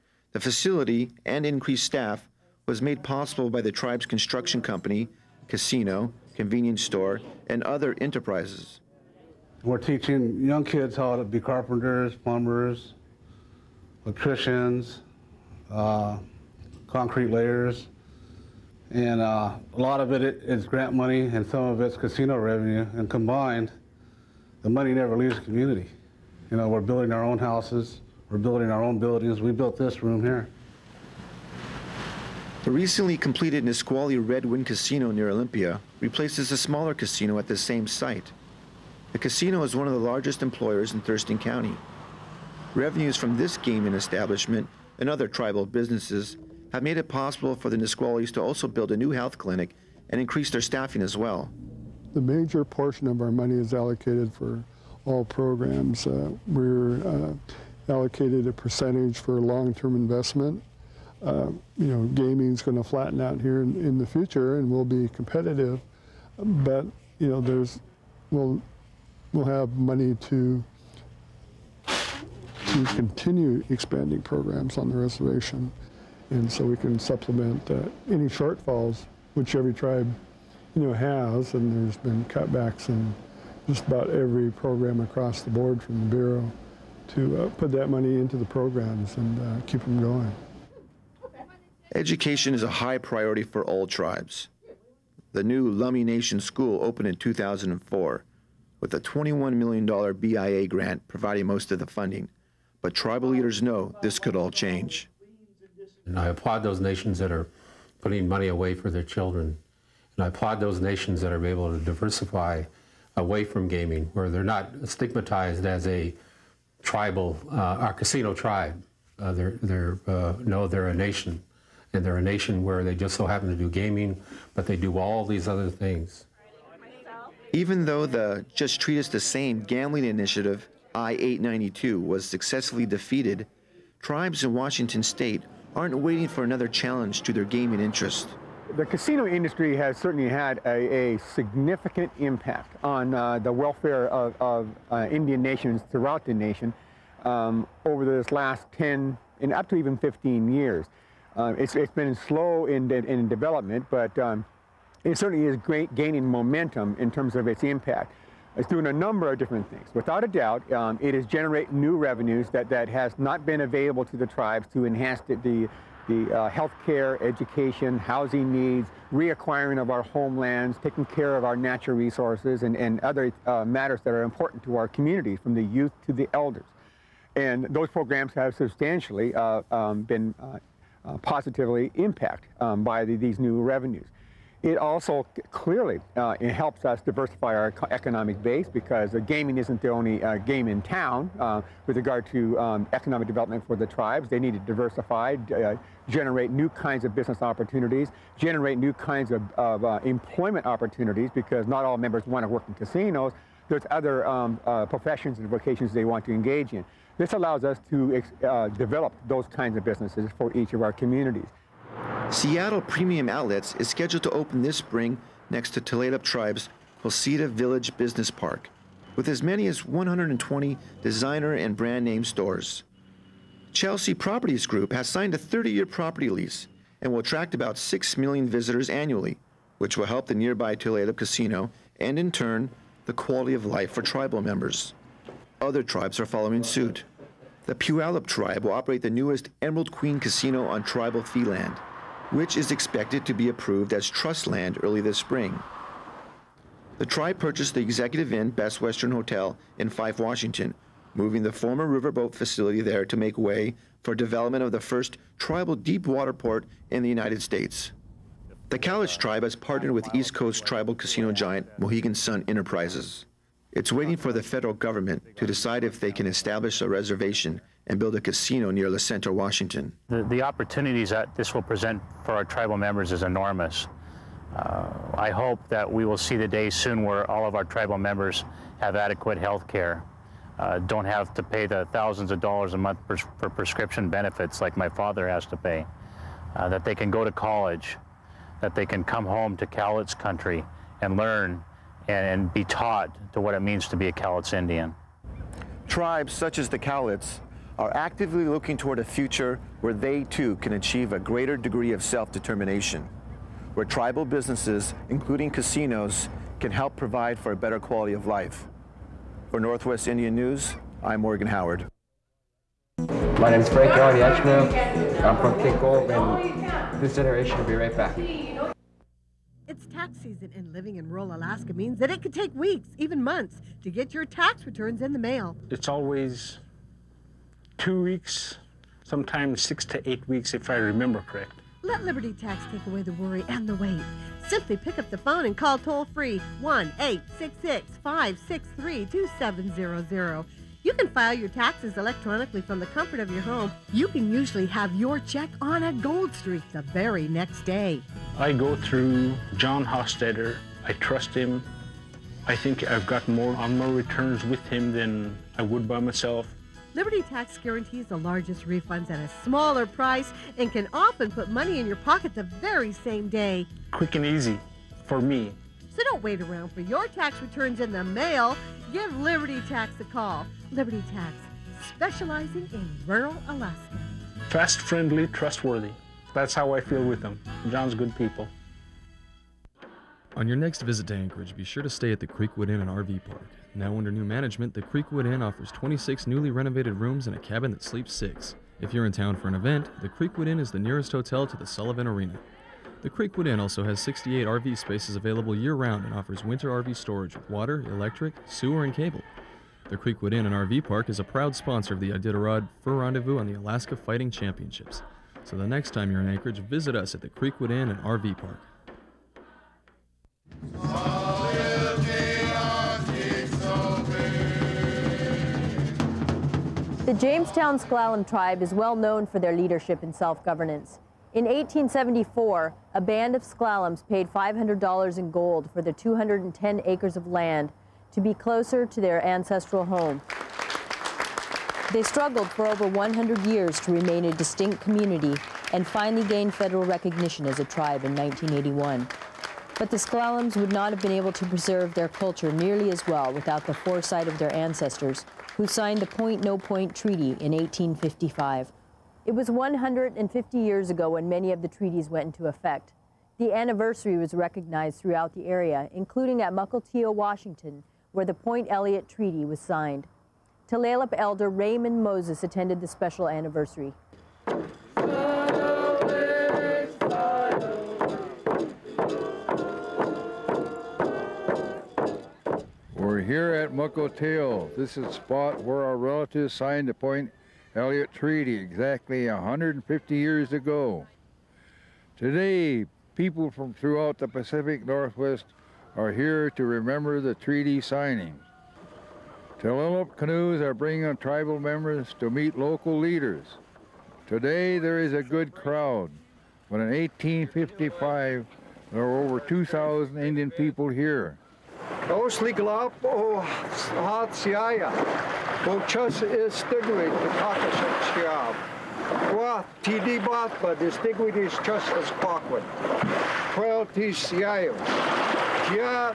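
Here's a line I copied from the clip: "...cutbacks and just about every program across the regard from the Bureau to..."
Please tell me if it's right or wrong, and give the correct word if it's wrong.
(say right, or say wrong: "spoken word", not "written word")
wrong: "board", not "regard".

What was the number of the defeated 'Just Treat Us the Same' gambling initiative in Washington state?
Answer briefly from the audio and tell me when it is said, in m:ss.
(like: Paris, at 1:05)
I 892, at 2:10.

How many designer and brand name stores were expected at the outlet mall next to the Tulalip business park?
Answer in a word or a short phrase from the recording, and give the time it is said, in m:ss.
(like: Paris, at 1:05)
120, at 3:39.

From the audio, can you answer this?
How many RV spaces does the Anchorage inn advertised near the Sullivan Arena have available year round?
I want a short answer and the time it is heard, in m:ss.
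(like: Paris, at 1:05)
68, at 6:33.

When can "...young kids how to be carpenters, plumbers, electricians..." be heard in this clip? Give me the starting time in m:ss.
0:10.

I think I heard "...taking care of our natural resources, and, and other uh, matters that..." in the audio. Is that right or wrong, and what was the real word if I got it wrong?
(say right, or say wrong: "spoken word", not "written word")
right.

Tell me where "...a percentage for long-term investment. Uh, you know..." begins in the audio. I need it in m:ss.
0:58.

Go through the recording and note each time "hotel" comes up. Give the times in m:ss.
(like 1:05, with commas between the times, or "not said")
4:09, 6:31.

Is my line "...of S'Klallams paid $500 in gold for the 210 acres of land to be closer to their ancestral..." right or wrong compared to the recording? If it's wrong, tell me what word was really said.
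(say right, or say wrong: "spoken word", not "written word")
right.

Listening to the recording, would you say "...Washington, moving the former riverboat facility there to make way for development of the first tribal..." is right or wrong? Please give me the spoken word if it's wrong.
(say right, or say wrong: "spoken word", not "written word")
right.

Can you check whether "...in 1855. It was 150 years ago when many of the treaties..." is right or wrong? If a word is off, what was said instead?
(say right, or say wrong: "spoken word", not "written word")
right.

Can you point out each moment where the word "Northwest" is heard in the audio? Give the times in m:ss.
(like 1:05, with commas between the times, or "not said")
5:09, 8:04.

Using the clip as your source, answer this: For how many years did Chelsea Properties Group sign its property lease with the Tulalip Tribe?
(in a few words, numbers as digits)
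30 years.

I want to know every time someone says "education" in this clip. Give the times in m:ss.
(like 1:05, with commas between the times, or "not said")
1:31, 2:47.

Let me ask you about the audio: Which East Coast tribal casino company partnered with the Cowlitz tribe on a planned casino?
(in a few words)
Mohegan Sun Enterprises.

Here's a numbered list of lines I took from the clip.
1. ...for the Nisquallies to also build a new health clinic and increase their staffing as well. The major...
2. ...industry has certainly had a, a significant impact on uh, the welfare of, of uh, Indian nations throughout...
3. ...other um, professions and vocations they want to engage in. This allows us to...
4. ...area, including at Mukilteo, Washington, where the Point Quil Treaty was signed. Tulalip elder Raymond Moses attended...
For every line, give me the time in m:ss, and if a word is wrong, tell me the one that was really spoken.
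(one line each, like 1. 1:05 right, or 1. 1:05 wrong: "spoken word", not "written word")
1. 0:47 right
2. 2:19 right
3. 3:23 right
4. 7:35 wrong: "Elliott", not "Quil".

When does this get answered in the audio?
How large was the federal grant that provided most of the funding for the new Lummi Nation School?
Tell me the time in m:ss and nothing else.
1:38.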